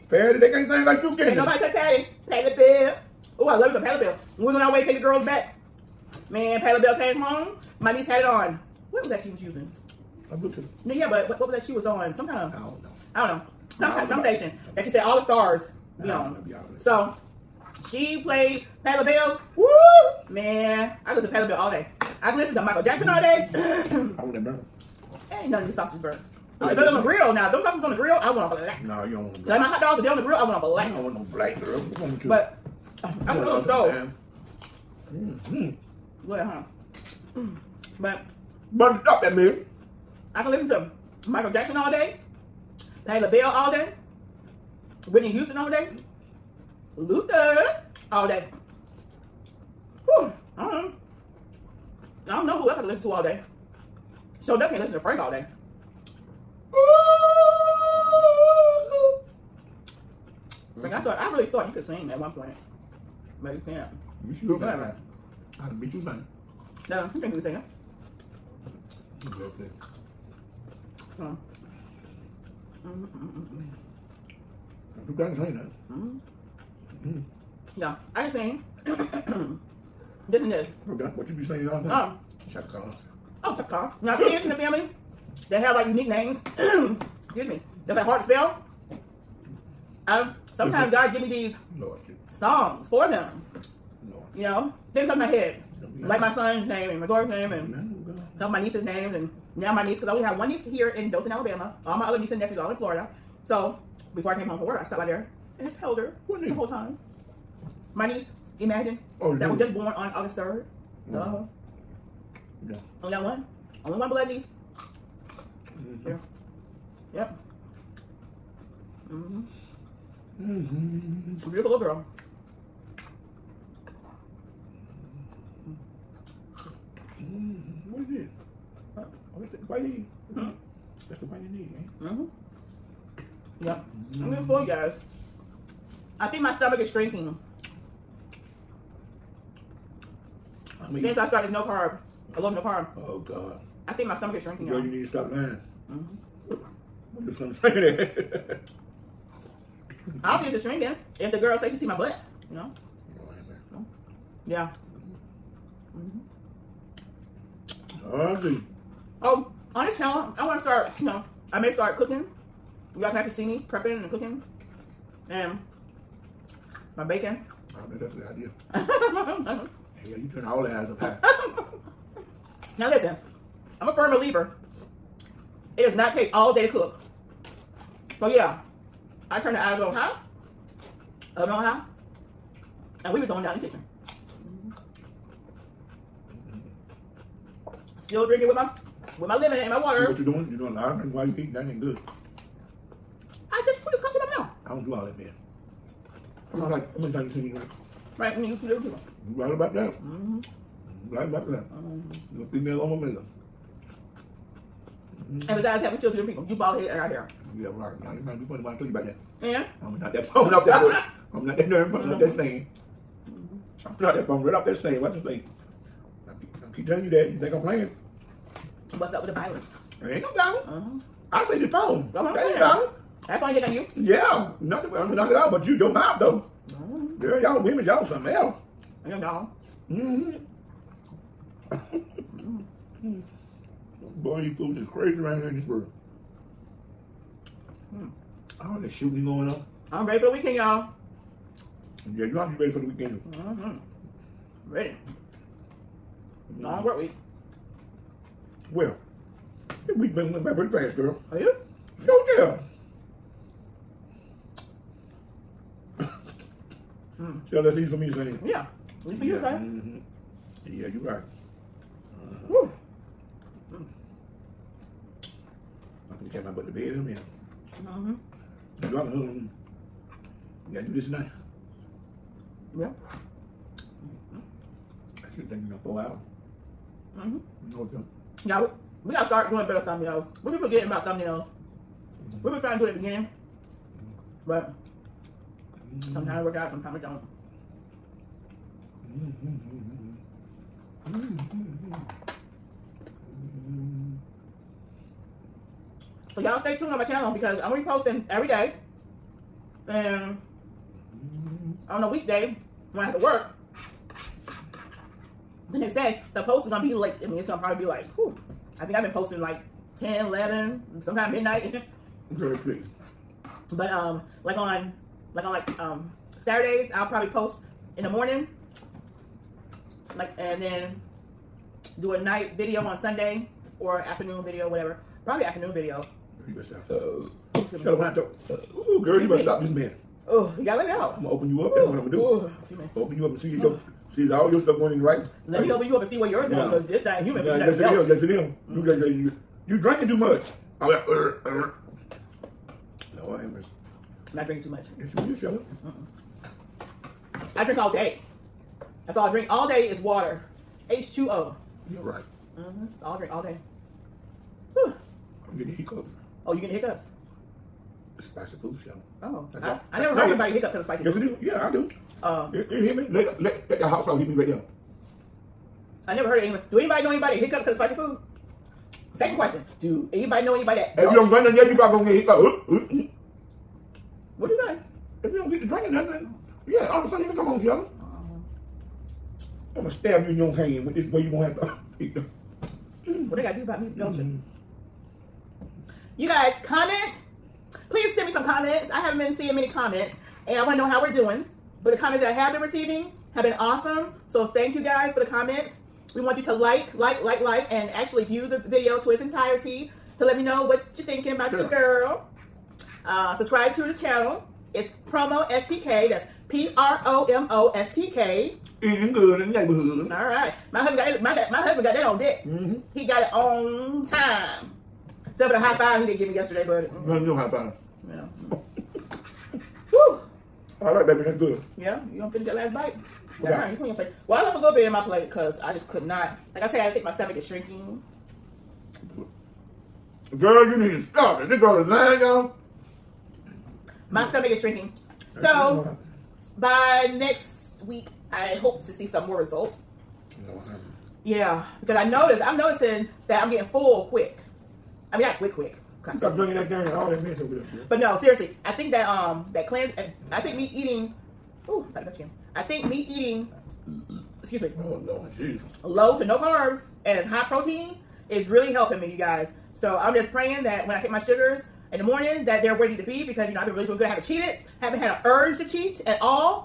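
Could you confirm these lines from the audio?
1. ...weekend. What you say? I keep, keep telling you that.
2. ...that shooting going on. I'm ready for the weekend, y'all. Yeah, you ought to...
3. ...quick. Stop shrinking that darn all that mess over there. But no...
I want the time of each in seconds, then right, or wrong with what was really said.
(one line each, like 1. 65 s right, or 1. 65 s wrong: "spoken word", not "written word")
1. 214 s wrong: "stand", not "weekend"
2. 238 s right
3. 445 s wrong: "drinking", not "shrinking".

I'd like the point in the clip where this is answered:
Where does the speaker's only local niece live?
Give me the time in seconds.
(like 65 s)
101 s.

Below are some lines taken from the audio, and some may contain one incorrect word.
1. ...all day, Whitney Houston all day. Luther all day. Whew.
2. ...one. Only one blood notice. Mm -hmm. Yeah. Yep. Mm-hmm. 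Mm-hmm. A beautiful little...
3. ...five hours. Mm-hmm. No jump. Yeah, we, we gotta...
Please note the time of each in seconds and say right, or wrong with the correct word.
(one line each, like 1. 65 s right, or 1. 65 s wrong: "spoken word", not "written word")
1. 43 s right
2. 113 s wrong: "niece", not "notice"
3. 275 s wrong: "four", not "five".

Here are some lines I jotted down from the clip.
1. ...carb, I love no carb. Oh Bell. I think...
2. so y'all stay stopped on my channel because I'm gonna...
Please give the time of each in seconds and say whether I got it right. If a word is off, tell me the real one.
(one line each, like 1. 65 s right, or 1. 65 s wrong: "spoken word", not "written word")
1. 141 s wrong: "God", not "Bell"
2. 296 s wrong: "tuned", not "stopped".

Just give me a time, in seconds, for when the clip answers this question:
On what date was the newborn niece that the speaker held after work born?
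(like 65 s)
110 s.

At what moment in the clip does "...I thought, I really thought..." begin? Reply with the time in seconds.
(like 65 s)
60 s.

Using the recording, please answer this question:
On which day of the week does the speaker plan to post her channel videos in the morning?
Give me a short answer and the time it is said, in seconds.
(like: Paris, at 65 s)
Saturdays, at 316 s.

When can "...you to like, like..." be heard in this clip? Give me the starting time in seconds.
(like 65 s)
396 s.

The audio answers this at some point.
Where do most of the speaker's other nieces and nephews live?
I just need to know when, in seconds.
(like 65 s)
102 s.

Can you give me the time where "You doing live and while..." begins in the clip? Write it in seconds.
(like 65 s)
190 s.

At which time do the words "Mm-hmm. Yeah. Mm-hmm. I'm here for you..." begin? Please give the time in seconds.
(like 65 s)
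132 s.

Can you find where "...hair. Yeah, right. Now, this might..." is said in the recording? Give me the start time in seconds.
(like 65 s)
207 s.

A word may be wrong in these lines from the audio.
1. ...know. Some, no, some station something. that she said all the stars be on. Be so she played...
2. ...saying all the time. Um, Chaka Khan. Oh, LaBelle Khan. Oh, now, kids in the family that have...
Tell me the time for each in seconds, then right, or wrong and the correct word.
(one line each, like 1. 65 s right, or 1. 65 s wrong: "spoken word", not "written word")
1. 13 s right
2. 81 s wrong: "Chaka", not "LaBelle".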